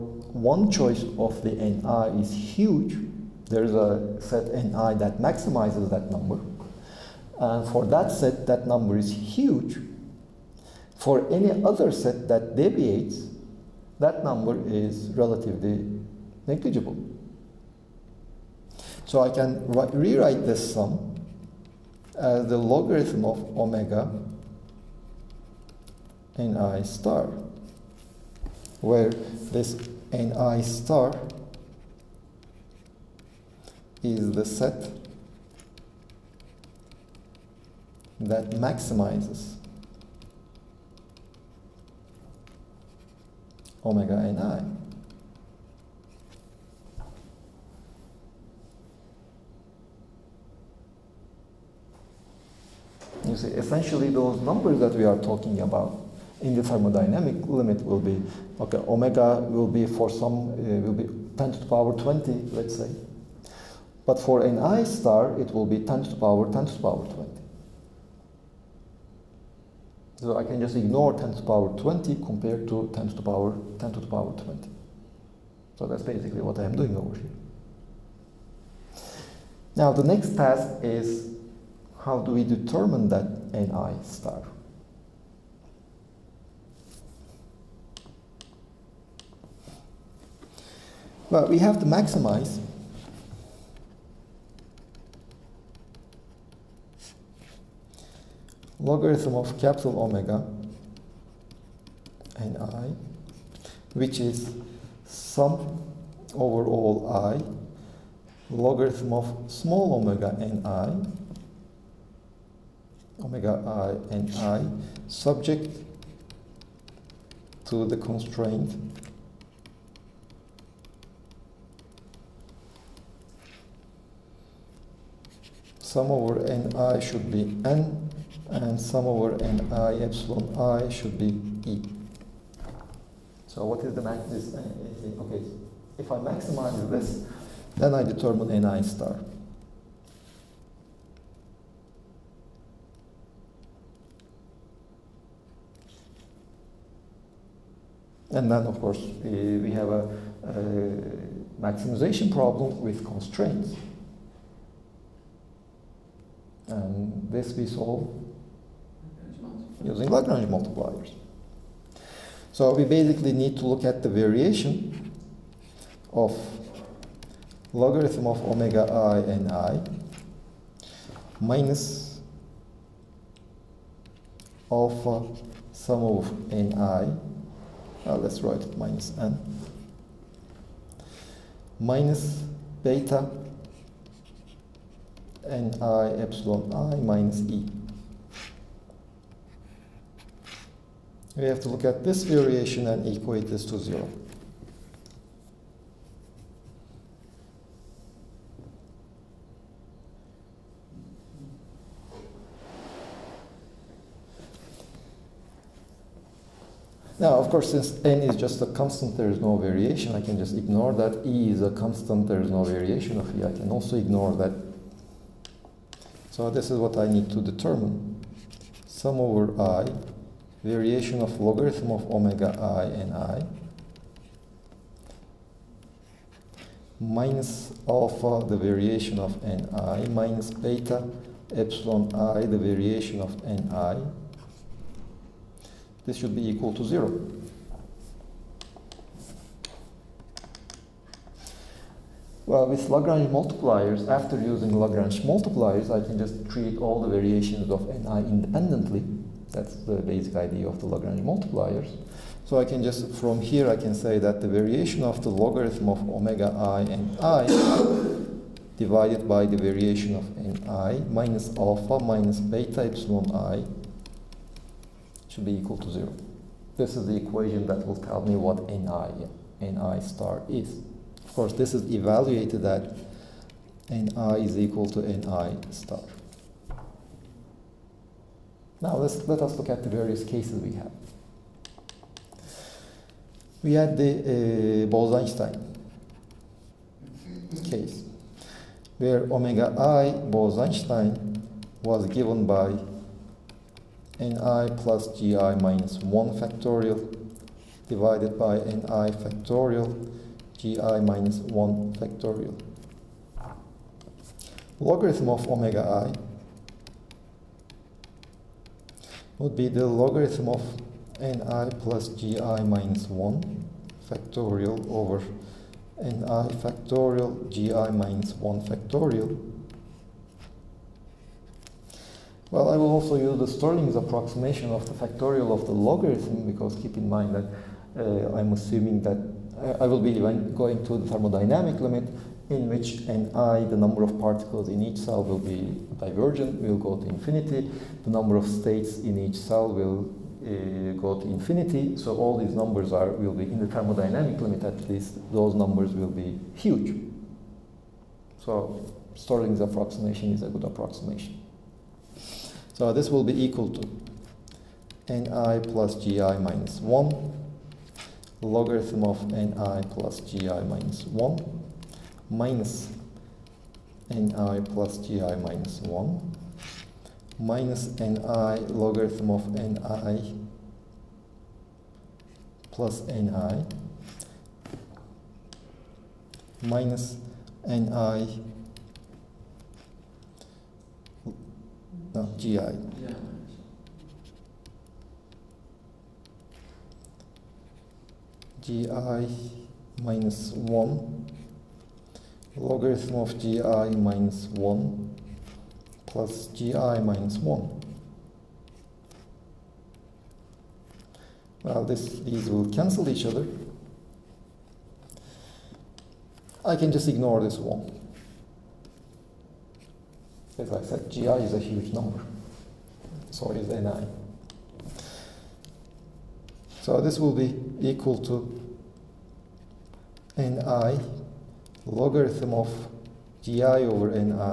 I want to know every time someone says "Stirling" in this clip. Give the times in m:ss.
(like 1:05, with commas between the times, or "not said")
5:23, 5:49.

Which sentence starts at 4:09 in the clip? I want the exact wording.
That's the basic idea of the Lagrange multipliers.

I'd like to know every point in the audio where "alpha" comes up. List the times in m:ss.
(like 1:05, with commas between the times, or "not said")
2:54, 3:47, 4:21.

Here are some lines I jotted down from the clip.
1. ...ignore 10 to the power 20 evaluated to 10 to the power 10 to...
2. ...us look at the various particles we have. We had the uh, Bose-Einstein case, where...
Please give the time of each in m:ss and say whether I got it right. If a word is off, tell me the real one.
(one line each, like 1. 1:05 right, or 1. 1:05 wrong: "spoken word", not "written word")
1. 1:10 wrong: "compared", not "evaluated"
2. 4:39 wrong: "cases", not "particles".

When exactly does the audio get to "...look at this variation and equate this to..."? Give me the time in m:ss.
3:11.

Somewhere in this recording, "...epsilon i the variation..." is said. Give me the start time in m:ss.
3:51.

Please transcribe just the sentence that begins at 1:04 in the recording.
But for an I star, it will be 10 to the power 10 to the power 20.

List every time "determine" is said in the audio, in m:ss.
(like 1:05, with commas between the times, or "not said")
1:22, 2:18, 3:37.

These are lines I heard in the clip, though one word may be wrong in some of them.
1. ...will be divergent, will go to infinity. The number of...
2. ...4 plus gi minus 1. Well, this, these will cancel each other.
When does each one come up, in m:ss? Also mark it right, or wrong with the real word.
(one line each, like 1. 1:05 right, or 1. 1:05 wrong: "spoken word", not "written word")
1. 5:35 right
2. 6:34 wrong: "1", not "4".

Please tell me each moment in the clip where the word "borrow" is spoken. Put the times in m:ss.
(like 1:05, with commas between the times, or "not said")
not said.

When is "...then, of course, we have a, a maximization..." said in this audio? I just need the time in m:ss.
2:28.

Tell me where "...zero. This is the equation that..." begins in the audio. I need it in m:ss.
4:25.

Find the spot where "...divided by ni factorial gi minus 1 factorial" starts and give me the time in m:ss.
4:57.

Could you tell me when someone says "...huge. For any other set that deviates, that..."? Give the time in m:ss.
0:09.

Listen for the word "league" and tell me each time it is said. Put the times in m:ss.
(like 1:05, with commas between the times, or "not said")
not said.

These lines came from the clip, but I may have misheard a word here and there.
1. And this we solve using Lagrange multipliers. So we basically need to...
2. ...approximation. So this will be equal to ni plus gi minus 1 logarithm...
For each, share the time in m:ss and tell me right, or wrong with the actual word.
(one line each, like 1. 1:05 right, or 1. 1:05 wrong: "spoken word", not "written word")
1. 2:36 right
2. 5:50 right.